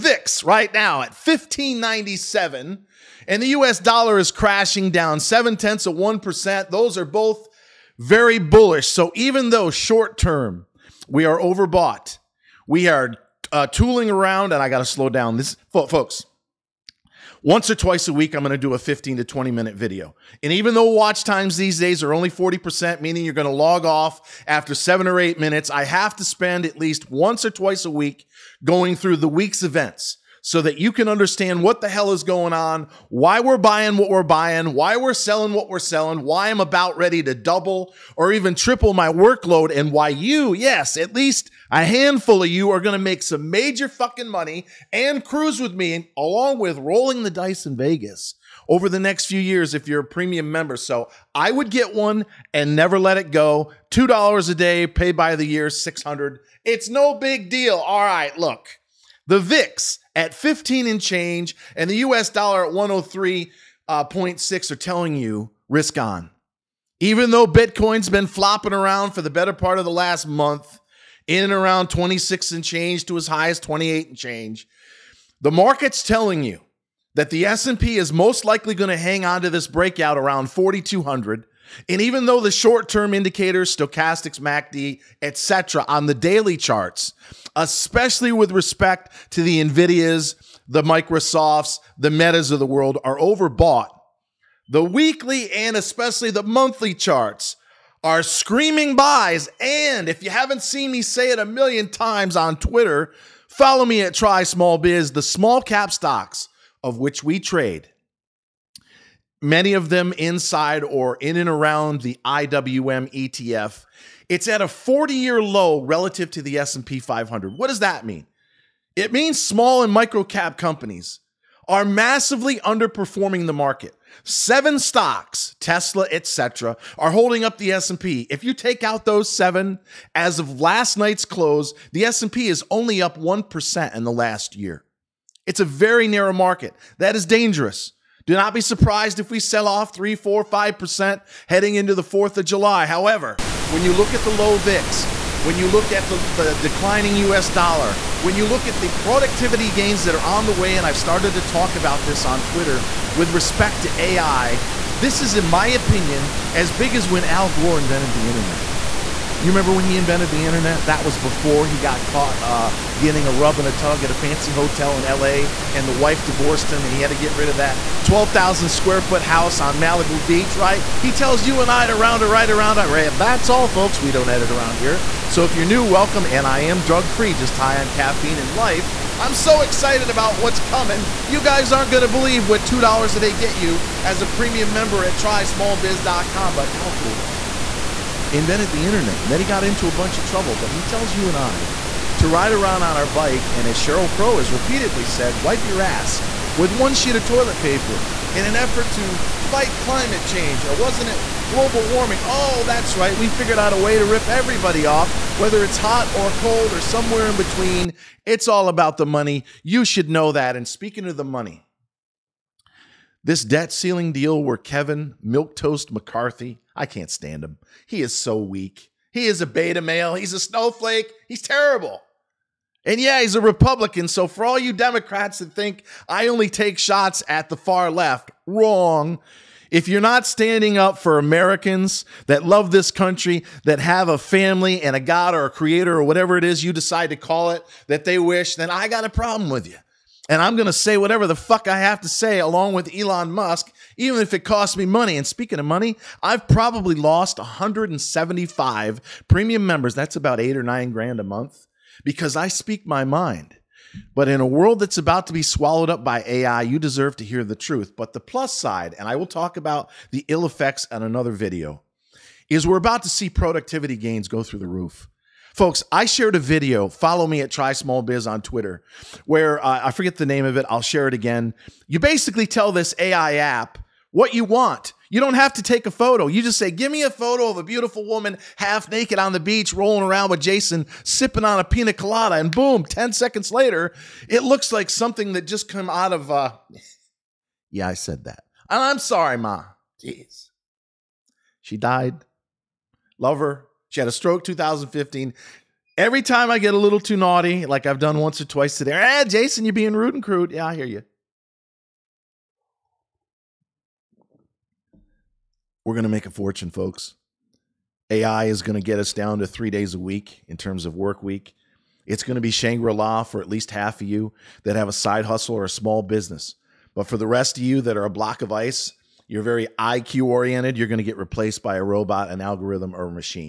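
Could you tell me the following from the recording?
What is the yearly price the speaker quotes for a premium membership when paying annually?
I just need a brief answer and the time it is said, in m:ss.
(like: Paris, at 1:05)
600, at 0:55.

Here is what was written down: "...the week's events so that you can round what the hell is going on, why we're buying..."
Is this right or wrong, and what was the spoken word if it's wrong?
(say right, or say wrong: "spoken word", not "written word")
wrong: "understand", not "round".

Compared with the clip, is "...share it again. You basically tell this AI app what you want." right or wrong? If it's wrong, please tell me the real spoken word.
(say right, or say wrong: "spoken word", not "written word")
right.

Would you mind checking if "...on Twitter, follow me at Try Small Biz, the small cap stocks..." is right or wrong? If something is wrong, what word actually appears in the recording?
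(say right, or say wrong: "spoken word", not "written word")
right.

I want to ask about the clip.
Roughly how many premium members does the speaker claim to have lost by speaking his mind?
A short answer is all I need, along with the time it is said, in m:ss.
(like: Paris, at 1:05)
175, at 4:07.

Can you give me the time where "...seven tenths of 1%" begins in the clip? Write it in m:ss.
0:05.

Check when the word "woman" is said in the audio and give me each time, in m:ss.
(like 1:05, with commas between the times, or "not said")
4:38.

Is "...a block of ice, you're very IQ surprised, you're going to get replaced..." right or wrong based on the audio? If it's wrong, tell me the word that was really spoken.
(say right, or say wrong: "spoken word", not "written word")
wrong: "oriented", not "surprised".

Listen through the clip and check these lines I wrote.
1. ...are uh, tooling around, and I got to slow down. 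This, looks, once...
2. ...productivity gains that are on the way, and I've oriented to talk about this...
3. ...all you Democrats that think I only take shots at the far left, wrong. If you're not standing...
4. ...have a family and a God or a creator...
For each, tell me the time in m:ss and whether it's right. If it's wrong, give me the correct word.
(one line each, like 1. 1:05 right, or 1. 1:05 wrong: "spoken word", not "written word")
1. 0:12 wrong: "folks", not "looks"
2. 2:28 wrong: "started", not "oriented"
3. 3:44 right
4. 3:53 right.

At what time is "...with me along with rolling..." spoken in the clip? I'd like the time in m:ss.
0:45.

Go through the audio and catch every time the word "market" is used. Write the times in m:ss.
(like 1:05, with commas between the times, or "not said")
1:15, 2:03, 2:16.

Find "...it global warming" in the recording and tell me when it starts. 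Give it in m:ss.
3:21.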